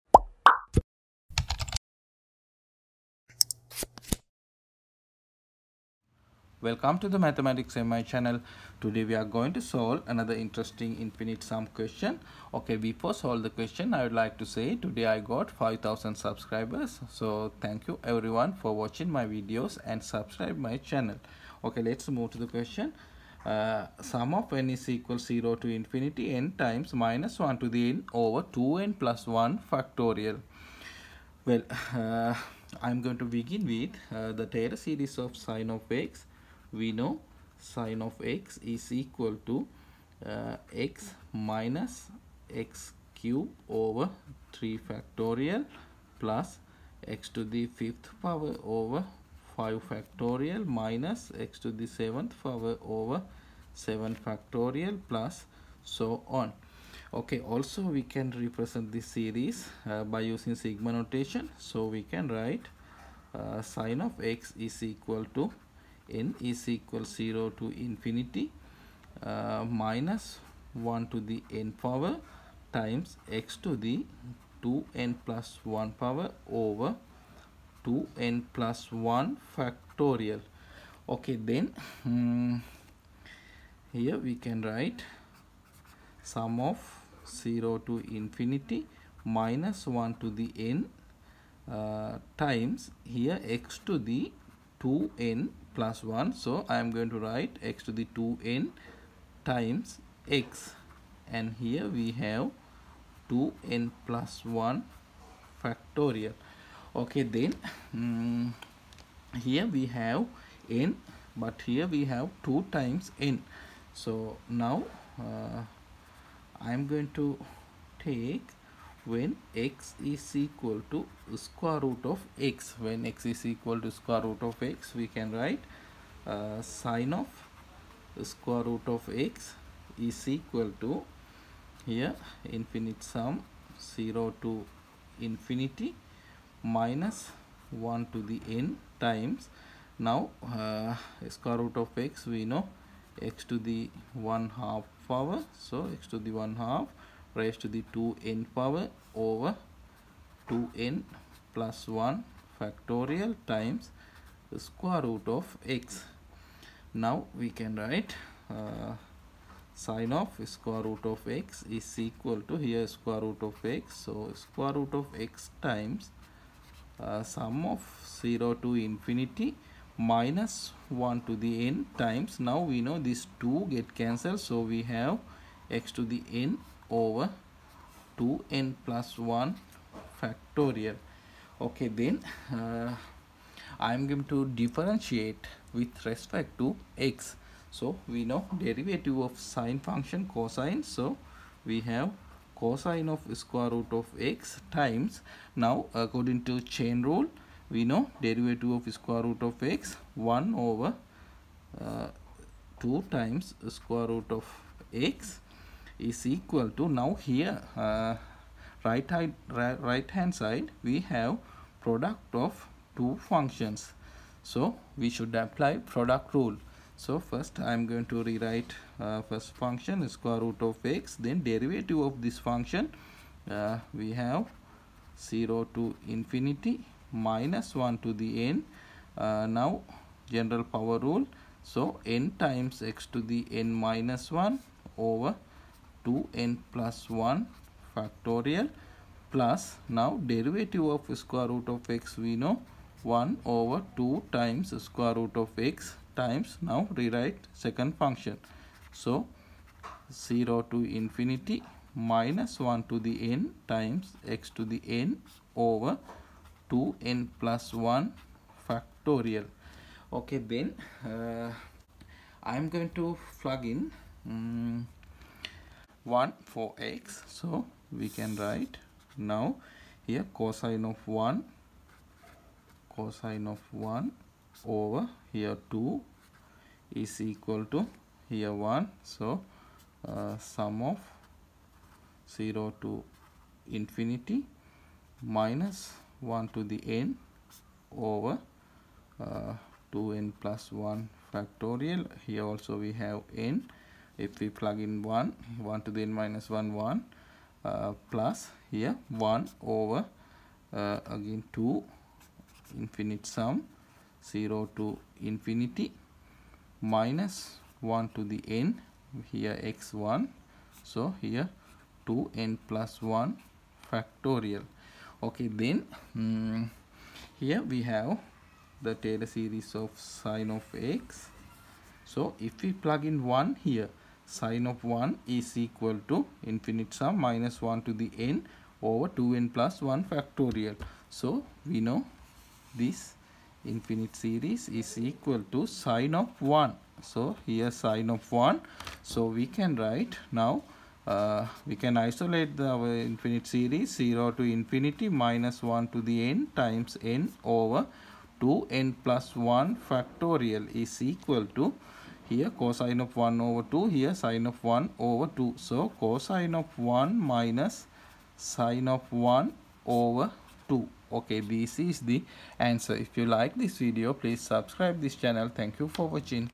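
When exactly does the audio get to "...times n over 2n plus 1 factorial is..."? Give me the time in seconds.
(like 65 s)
346 s.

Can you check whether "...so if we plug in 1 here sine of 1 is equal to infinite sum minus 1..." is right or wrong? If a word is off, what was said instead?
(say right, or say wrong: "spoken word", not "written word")
right.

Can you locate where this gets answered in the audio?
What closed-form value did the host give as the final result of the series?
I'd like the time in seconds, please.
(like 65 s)
356 s.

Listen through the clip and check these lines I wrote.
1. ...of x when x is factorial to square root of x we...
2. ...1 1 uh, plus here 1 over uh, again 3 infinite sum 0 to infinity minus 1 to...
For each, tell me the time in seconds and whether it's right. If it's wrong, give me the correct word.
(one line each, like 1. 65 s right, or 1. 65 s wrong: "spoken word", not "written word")
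1. 122 s wrong: "equal", not "factorial"
2. 296 s wrong: "2", not "3".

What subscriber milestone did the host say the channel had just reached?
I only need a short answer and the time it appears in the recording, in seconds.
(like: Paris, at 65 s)
5000, at 15 s.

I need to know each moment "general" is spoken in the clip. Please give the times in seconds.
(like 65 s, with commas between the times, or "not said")
230 s.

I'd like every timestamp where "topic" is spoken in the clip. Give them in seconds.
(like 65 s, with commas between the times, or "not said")
not said.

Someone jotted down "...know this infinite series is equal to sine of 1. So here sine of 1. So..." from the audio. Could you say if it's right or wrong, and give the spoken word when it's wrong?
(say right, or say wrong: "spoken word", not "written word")
right.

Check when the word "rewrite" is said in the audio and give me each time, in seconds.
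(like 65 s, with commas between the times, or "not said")
218 s, 246 s.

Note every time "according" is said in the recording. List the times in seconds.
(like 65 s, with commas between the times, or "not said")
195 s.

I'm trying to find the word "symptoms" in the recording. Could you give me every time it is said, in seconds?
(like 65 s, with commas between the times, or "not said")
not said.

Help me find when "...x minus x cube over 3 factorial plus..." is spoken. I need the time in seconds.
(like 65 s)
40 s.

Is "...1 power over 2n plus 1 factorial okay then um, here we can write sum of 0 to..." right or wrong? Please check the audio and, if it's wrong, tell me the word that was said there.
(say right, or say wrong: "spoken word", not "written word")
right.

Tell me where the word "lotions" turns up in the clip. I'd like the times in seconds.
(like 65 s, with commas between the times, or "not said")
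not said.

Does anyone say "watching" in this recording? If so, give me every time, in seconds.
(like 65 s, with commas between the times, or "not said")
18 s, 366 s.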